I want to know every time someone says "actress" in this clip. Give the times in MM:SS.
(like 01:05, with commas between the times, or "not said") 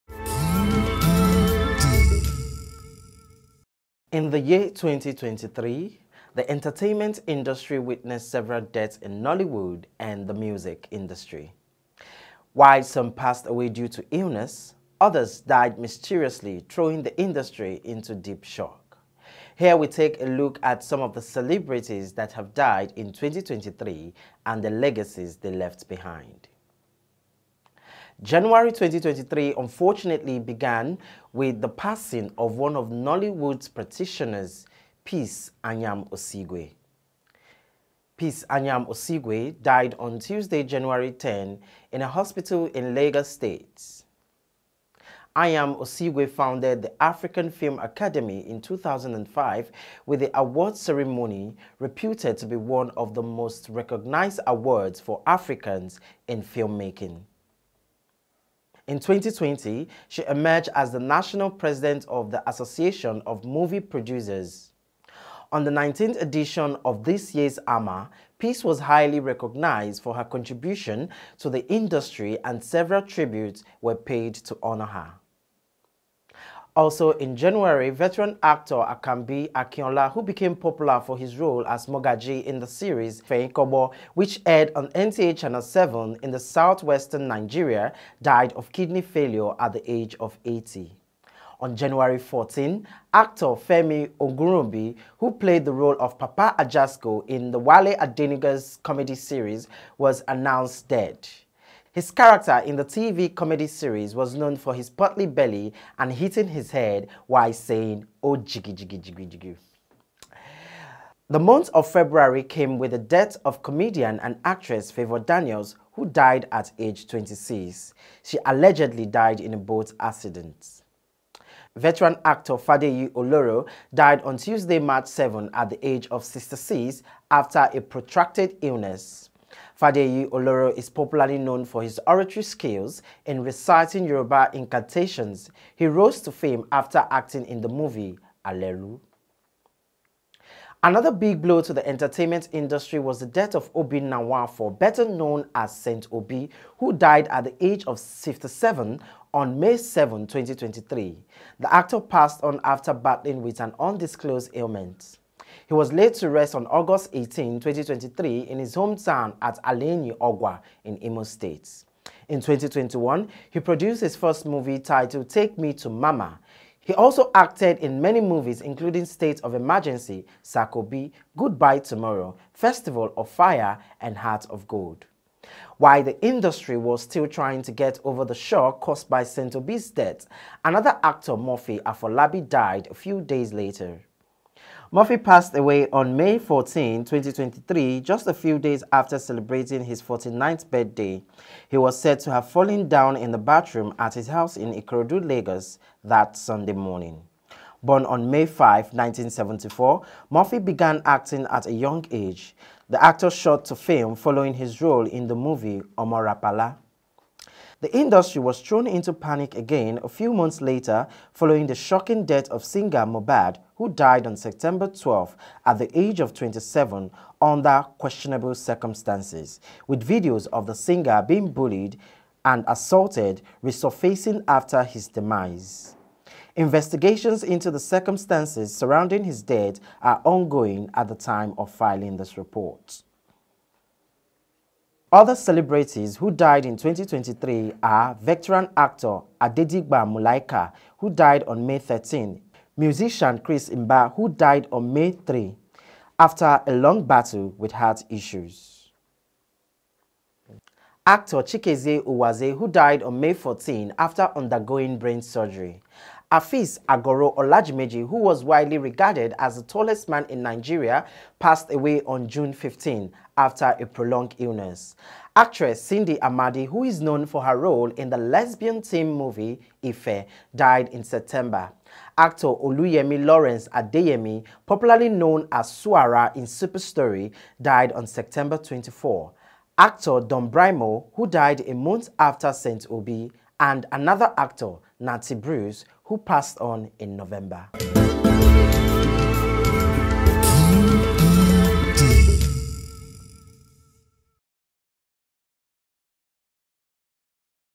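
01:54, 04:25.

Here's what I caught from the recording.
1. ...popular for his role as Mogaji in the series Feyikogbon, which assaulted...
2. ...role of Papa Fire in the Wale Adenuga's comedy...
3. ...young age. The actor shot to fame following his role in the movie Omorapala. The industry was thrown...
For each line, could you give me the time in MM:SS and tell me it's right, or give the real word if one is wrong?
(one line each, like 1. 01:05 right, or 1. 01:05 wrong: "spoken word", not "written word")
1. 01:20 wrong: "aired", not "assaulted"
2. 01:35 wrong: "Ajasco", not "Fire"
3. 03:21 right.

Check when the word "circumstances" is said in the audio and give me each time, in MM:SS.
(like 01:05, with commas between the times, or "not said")
03:38, 03:47.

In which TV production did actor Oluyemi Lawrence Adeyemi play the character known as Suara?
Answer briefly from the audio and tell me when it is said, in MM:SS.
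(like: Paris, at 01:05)
Super Story, at 04:36.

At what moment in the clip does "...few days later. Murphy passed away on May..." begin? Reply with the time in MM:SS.
03:02.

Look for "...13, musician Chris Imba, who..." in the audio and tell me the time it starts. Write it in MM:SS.
04:01.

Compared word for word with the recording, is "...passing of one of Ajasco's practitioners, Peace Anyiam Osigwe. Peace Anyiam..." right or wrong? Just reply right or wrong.
wrong.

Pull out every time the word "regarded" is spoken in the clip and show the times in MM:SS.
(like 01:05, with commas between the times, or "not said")
04:18.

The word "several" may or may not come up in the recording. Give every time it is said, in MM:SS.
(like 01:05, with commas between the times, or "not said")
00:08, 01:12.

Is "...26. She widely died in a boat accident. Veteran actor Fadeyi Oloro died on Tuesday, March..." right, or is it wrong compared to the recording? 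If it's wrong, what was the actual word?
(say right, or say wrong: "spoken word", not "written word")
wrong: "allegedly", not "widely".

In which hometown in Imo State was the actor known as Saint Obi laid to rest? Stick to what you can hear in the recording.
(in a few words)
Aleni Ogwa.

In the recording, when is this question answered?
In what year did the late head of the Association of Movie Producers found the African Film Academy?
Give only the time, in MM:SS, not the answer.
00:48.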